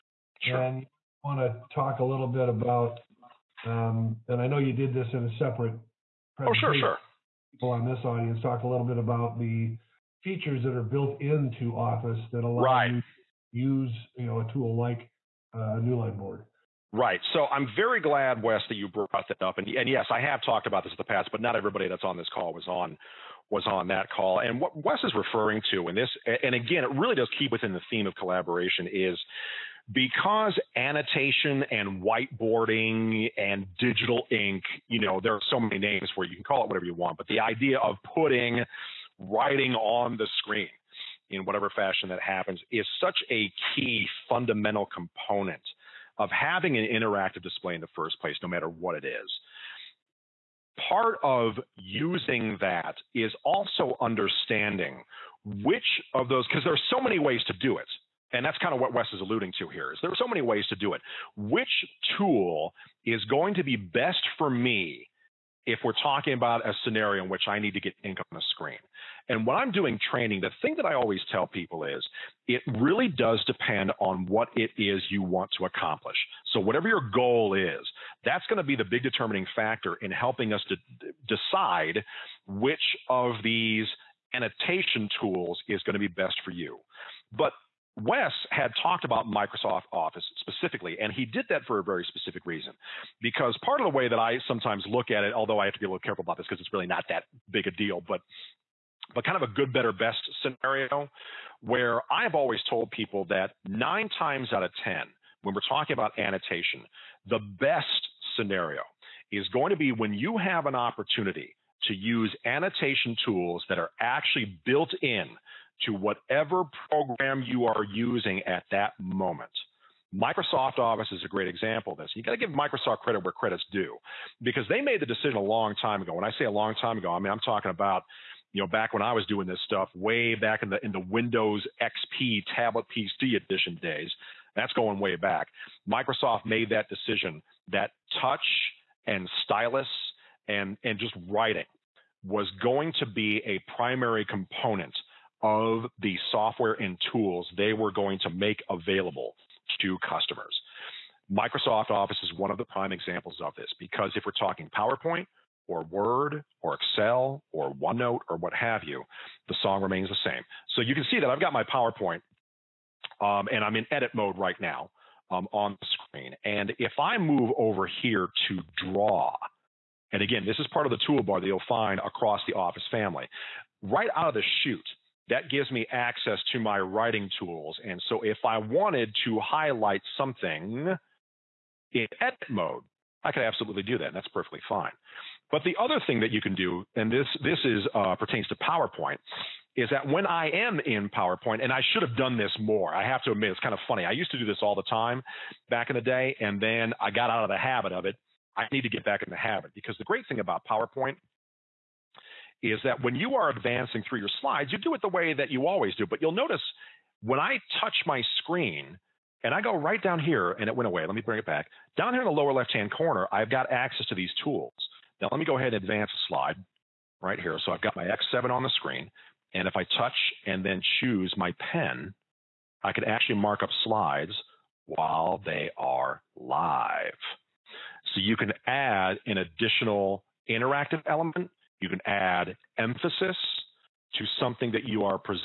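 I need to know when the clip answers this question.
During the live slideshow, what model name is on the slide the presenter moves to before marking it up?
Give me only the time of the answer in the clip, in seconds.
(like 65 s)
218 s.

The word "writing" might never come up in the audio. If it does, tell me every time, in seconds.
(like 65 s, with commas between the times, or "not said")
39 s, 141 s, 176 s.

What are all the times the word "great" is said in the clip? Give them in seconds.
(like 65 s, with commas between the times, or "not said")
121 s, 200 s.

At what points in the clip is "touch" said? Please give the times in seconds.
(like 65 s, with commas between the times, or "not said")
138 s, 207 s, 219 s.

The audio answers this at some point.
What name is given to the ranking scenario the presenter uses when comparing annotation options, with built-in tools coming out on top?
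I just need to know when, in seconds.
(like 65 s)
99 s.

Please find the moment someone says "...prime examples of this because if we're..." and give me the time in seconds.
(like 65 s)
152 s.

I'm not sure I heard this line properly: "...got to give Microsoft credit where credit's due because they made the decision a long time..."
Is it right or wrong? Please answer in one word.
right.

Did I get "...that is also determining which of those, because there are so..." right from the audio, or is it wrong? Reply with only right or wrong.
wrong.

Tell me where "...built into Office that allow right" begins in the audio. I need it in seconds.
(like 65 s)
10 s.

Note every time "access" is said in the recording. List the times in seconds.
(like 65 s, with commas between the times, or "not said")
175 s, 213 s.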